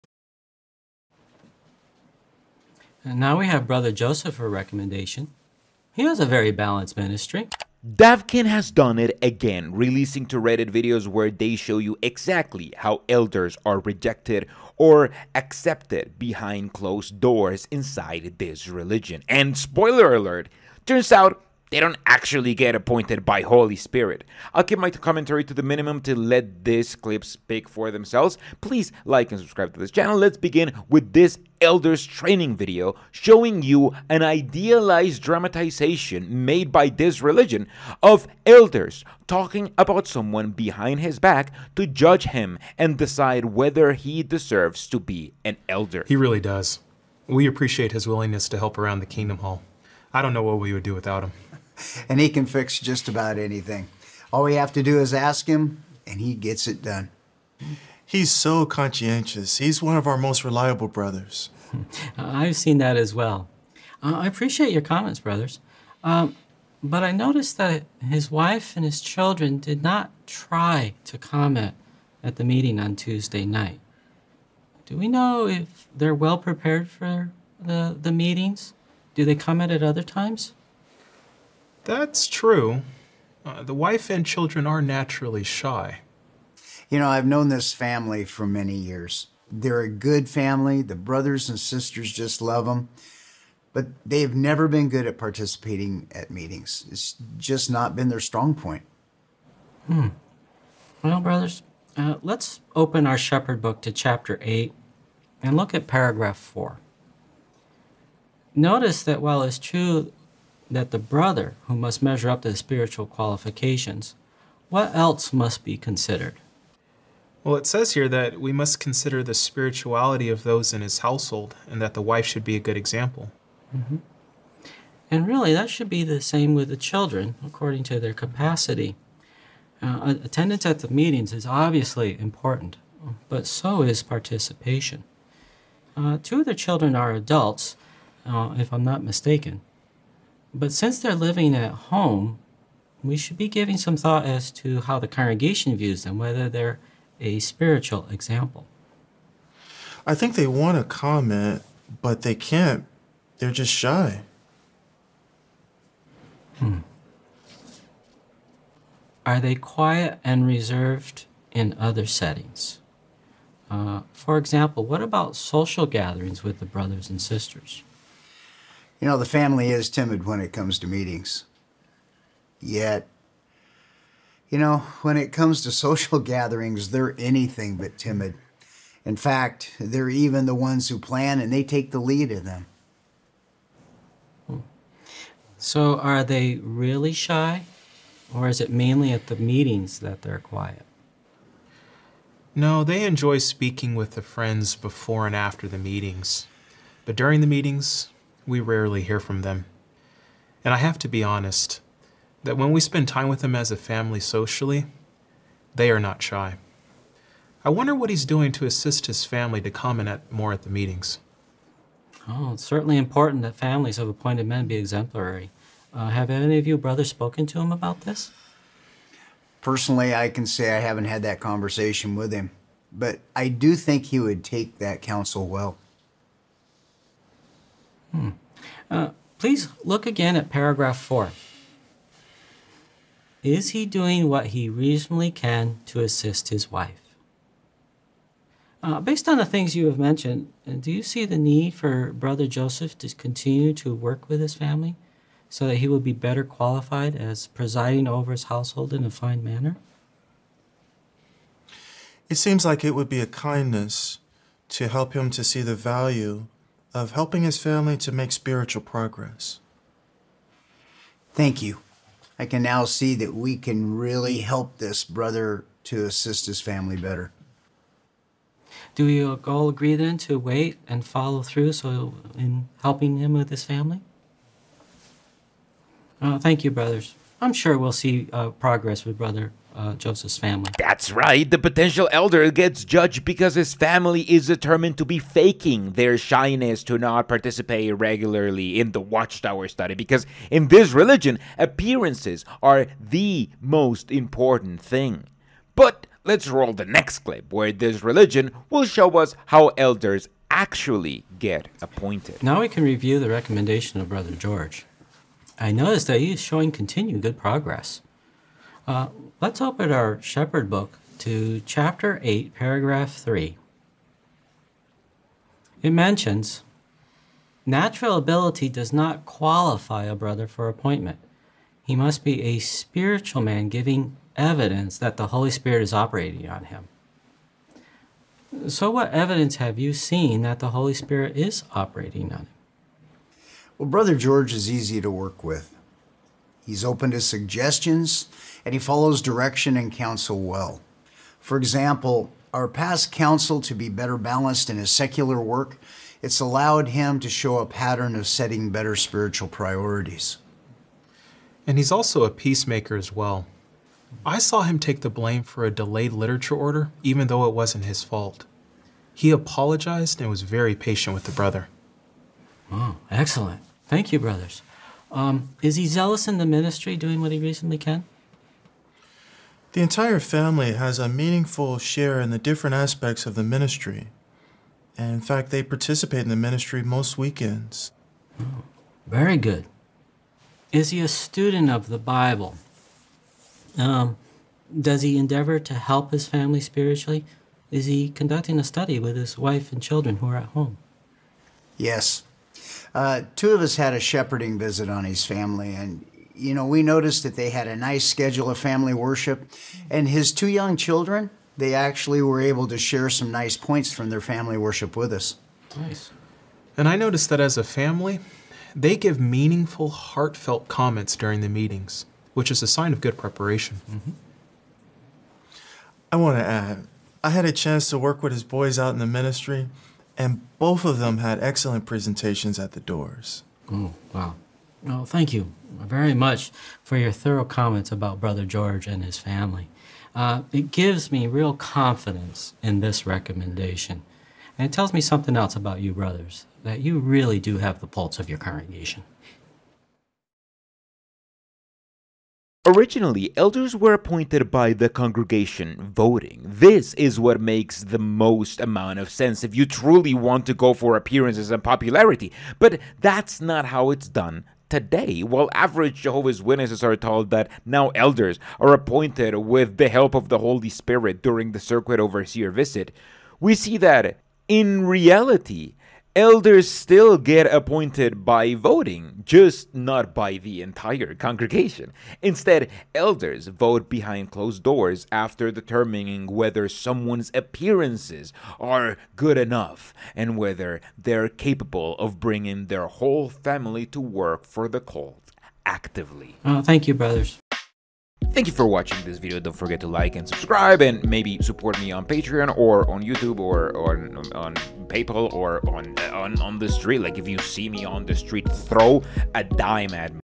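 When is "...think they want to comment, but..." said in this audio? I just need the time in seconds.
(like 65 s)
150 s.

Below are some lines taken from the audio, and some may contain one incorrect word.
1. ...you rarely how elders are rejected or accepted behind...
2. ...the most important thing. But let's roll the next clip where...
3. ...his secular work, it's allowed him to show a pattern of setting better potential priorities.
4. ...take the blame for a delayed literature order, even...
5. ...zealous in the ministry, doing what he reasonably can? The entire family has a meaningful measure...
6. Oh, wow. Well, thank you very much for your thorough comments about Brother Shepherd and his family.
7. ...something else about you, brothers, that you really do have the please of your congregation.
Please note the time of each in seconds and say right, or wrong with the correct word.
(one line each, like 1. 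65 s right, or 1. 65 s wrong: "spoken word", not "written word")
1. 11 s wrong: "exactly", not "rarely"
2. 292 s right
3. 344 s wrong: "spiritual", not "potential"
4. 354 s right
5. 365 s wrong: "share", not "measure"
6. 423 s wrong: "George", not "Shepherd"
7. 435 s wrong: "pulse", not "please".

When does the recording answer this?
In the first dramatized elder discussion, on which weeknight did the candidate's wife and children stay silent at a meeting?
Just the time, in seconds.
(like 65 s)
72 s.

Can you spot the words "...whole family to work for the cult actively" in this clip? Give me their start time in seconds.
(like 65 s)
482 s.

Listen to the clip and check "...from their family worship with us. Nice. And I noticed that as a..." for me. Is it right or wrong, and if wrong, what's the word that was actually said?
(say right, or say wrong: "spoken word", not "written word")
right.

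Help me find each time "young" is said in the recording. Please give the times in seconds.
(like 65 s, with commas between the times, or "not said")
400 s.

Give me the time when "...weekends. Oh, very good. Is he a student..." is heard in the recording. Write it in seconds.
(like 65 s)
377 s.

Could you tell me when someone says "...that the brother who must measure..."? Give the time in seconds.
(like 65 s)
110 s.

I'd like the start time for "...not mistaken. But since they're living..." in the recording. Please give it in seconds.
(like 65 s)
138 s.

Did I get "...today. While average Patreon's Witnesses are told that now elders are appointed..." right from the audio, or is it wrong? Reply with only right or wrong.
wrong.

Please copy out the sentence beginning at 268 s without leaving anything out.
Do we all agree then to wait and follow through so in helping him with his family?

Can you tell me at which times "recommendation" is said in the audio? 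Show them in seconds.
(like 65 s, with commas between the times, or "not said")
4 s, 303 s, 433 s.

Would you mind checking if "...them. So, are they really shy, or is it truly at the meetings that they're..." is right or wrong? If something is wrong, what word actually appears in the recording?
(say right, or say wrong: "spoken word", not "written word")
wrong: "mainly", not "truly".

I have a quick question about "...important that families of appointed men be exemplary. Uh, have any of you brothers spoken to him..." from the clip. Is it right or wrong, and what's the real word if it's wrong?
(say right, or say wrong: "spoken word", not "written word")
right.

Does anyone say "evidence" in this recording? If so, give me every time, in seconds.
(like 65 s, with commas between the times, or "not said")
324 s, 329 s.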